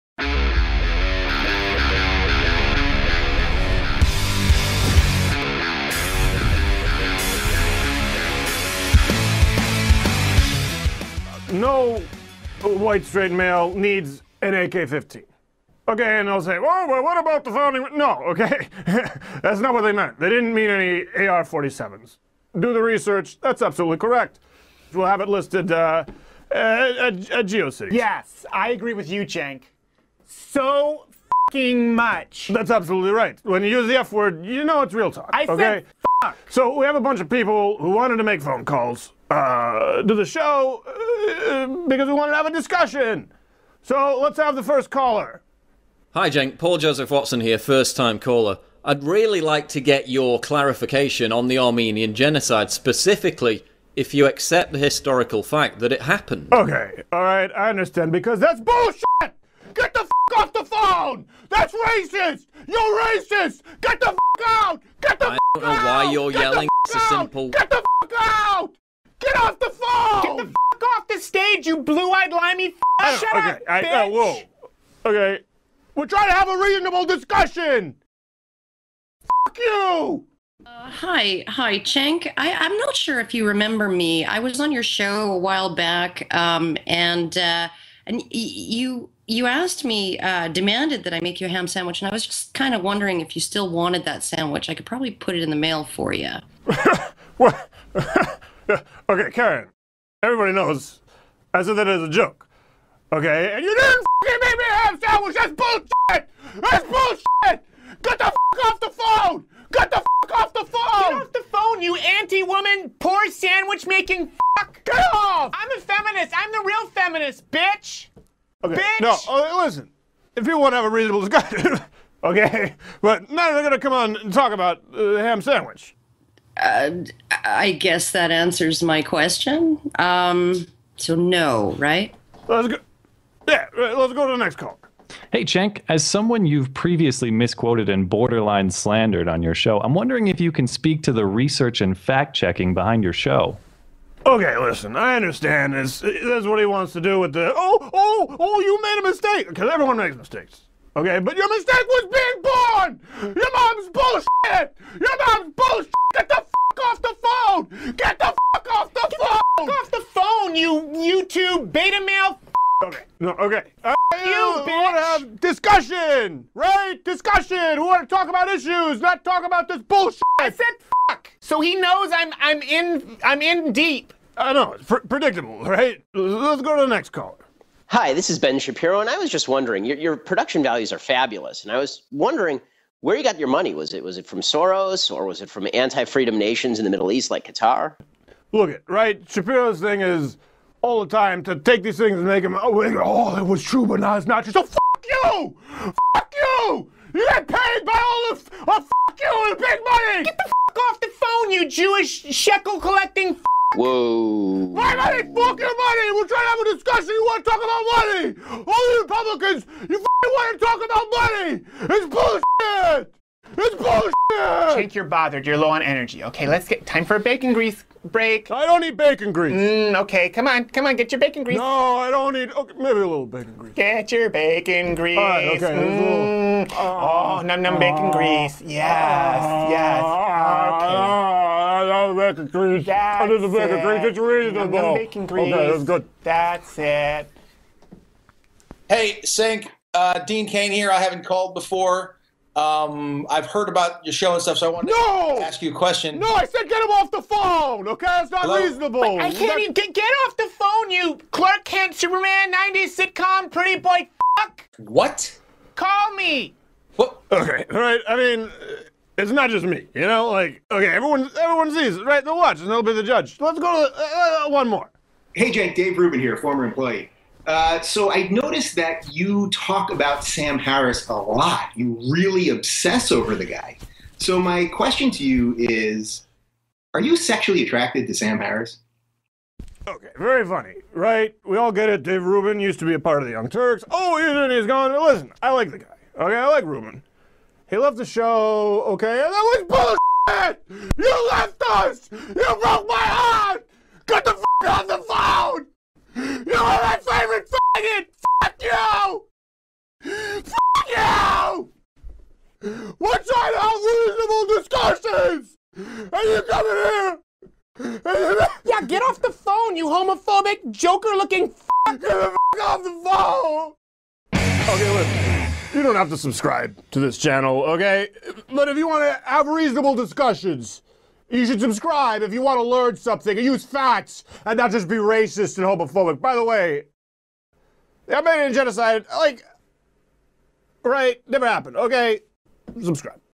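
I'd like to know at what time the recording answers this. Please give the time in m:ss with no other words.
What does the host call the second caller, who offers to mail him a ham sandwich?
1:39.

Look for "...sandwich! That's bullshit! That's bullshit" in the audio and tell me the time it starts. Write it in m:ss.
1:45.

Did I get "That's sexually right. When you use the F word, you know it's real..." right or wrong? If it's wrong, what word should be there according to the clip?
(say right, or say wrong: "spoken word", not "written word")
wrong: "absolutely", not "sexually".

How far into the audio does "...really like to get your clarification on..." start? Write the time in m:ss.
0:49.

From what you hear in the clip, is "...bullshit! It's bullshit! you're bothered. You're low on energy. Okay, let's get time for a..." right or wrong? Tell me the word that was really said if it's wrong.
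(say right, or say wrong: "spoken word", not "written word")
right.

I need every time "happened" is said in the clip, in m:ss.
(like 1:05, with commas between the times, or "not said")
0:56, 5:31.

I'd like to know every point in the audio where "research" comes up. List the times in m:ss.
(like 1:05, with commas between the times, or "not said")
0:22, 2:21.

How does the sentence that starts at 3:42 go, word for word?
Okay, maybe a little bacon grease.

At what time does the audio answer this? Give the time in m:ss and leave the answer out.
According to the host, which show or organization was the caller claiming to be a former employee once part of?
4:43.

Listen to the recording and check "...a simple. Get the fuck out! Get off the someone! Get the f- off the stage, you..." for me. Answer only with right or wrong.
wrong.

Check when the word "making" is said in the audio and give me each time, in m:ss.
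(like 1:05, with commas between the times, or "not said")
1:53.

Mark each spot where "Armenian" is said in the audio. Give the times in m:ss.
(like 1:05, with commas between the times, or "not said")
0:51, 5:28.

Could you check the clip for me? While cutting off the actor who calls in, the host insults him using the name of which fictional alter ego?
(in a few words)
Clark Kent.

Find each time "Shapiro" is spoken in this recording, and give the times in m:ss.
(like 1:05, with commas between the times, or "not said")
2:58, 3:09.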